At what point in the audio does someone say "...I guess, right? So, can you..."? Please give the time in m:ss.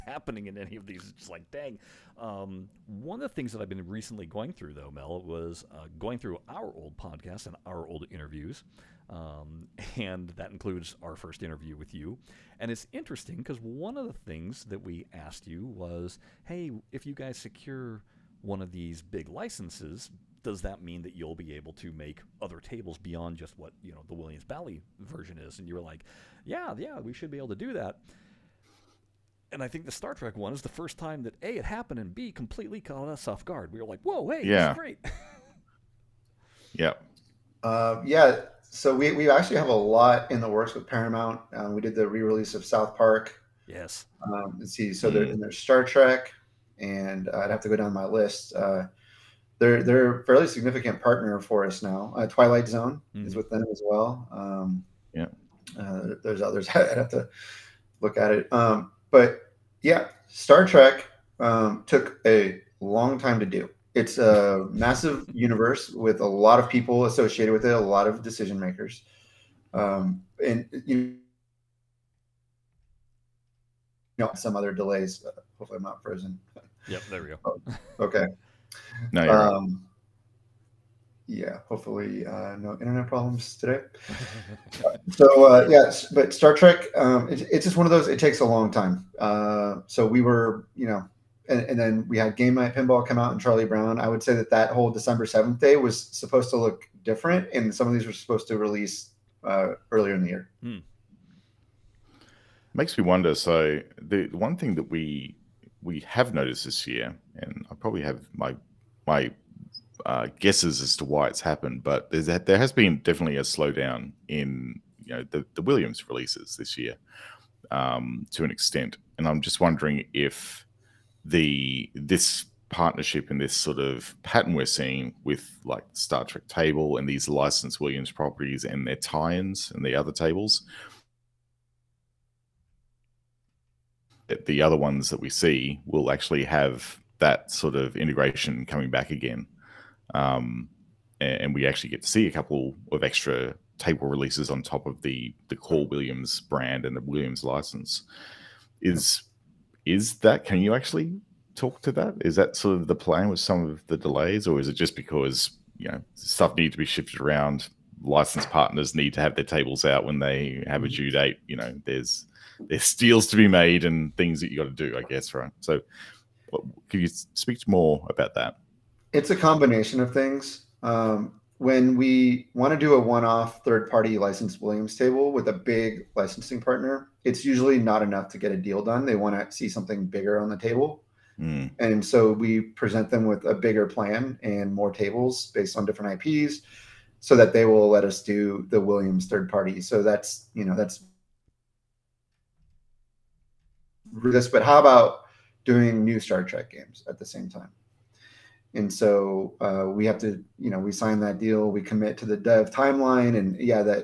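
2:44.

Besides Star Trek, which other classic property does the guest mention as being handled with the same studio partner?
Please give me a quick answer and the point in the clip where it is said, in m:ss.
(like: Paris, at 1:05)
Twilight Zone, at 0:52.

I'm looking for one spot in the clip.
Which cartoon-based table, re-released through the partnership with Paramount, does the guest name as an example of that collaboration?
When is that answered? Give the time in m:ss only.
0:42.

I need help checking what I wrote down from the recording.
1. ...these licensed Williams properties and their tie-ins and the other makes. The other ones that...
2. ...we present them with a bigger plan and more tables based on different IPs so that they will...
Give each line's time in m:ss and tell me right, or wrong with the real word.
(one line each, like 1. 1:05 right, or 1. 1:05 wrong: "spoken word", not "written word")
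1. 2:07 wrong: "tables", not "makes"
2. 3:02 right.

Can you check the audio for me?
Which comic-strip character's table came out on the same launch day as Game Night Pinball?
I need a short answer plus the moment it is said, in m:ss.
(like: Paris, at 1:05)
Charlie Brown, at 1:33.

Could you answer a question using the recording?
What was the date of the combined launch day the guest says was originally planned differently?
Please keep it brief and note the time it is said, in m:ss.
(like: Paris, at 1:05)
December 7, at 1:34.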